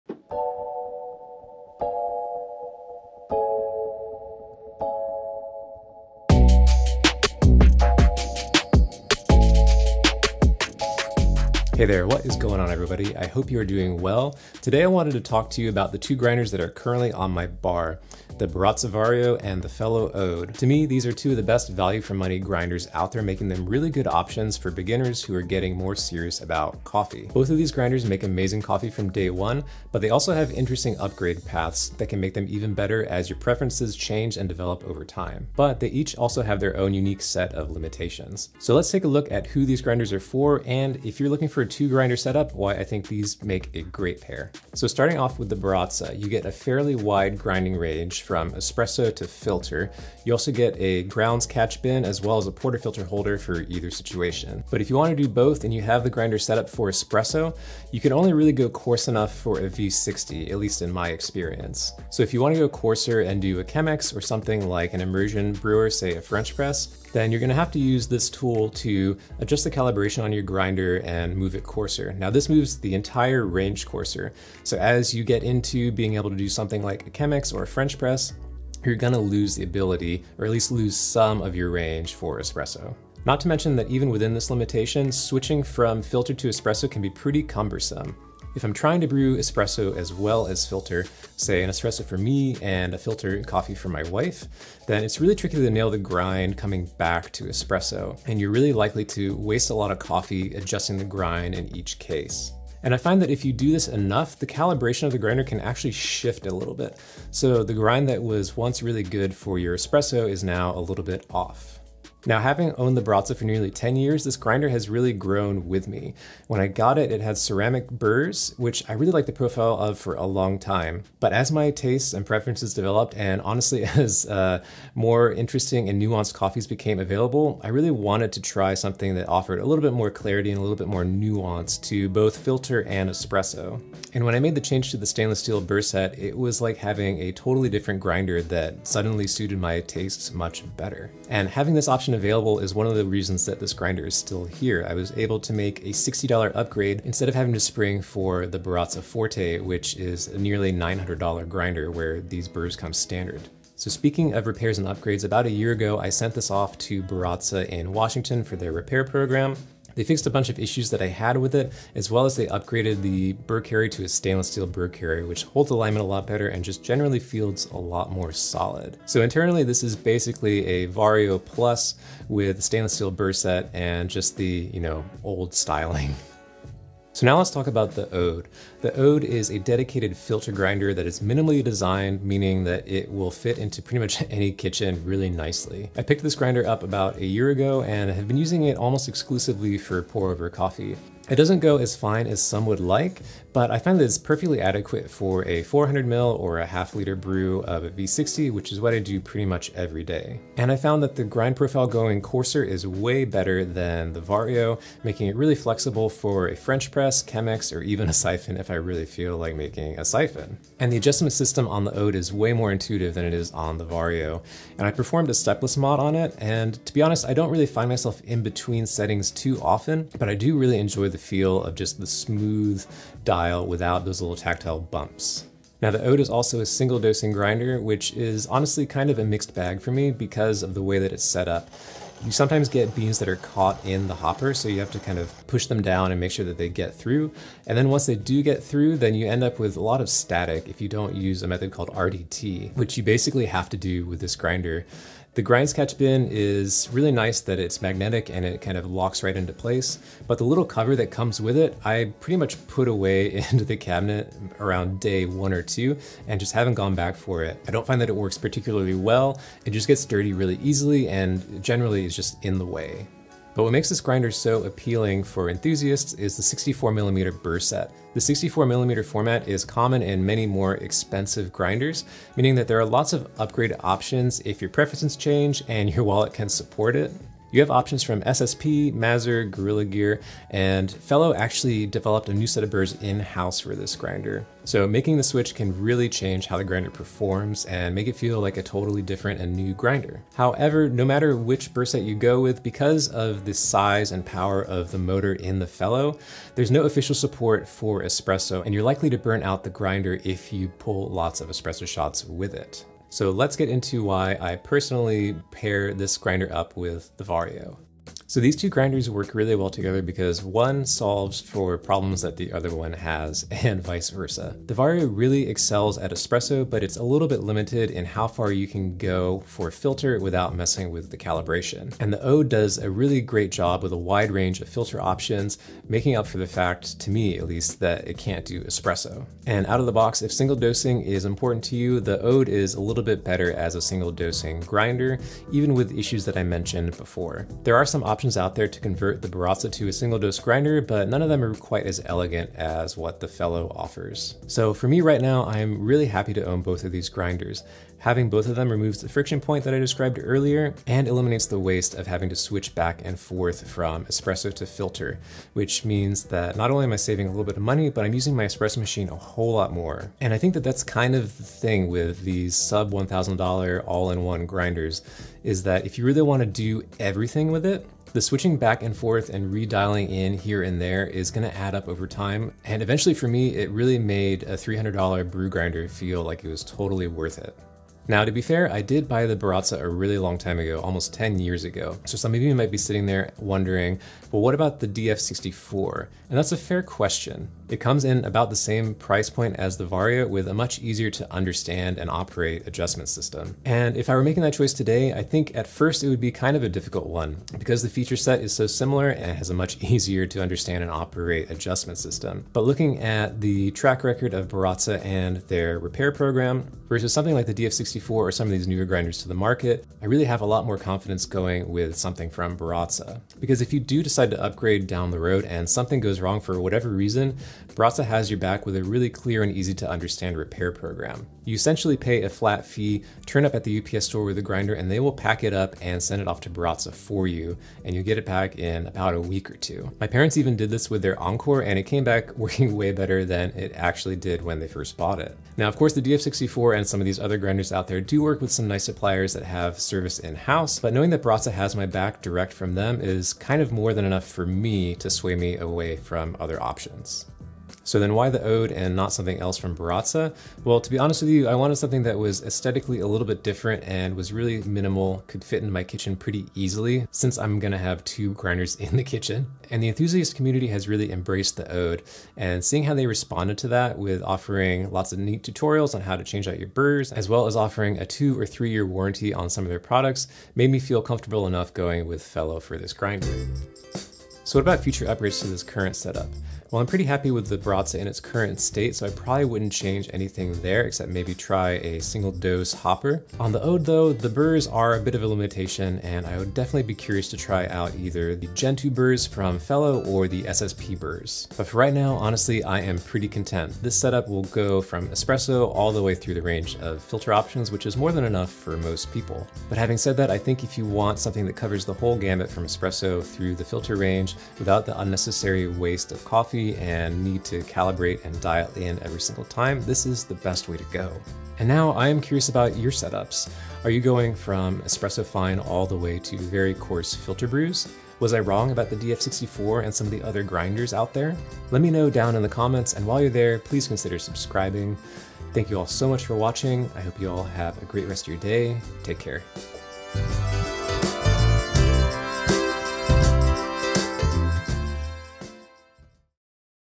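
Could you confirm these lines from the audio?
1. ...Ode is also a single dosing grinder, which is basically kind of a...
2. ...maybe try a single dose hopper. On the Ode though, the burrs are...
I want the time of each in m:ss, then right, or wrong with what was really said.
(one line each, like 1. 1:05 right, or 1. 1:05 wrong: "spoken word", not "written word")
1. 3:46 wrong: "honestly", not "basically"
2. 8:01 right.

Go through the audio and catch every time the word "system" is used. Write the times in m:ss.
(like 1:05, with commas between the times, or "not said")
3:31, 6:33, 6:41.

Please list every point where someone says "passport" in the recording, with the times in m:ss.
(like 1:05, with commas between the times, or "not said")
not said.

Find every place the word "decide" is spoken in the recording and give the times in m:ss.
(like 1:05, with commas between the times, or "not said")
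6:54.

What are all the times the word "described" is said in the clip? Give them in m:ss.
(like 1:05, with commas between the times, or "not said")
5:49.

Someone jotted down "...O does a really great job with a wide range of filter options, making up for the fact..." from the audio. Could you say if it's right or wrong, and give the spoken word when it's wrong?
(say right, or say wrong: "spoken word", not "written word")
right.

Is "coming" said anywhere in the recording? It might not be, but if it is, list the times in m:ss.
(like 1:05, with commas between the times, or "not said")
1:36.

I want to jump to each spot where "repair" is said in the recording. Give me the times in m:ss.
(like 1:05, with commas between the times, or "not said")
2:34, 2:38, 6:45, 7:00.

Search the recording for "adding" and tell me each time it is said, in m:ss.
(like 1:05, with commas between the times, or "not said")
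not said.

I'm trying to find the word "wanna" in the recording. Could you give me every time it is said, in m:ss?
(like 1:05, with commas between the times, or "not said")
0:54, 1:02.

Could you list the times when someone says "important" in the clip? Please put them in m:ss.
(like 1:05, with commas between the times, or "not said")
5:31.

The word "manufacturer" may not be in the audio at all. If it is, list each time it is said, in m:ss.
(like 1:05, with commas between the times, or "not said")
not said.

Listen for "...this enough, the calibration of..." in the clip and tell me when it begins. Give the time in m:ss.
1:43.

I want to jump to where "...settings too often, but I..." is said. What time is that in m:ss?
3:38.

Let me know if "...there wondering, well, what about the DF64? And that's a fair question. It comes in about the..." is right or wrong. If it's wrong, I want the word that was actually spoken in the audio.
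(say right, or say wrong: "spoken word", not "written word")
right.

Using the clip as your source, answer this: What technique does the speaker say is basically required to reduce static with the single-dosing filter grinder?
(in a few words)
RDT.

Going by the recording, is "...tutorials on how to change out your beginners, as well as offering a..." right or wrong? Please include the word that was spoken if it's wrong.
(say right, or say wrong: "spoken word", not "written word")
wrong: "burrs", not "beginners".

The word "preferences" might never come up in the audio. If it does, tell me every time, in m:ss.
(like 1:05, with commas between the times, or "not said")
0:33, 2:02, 4:34.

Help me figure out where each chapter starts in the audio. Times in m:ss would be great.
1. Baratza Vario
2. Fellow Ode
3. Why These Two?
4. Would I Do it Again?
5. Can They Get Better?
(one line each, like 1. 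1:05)
1. 0:44
2. 2:56
3. 5:08
4. 6:17
5. 7:53.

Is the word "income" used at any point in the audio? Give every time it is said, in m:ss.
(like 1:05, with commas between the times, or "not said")
not said.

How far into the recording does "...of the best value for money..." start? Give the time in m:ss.
0:21.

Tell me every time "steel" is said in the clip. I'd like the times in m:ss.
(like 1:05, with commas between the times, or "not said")
2:15, 2:44, 2:52.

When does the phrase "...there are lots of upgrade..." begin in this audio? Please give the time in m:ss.
4:32.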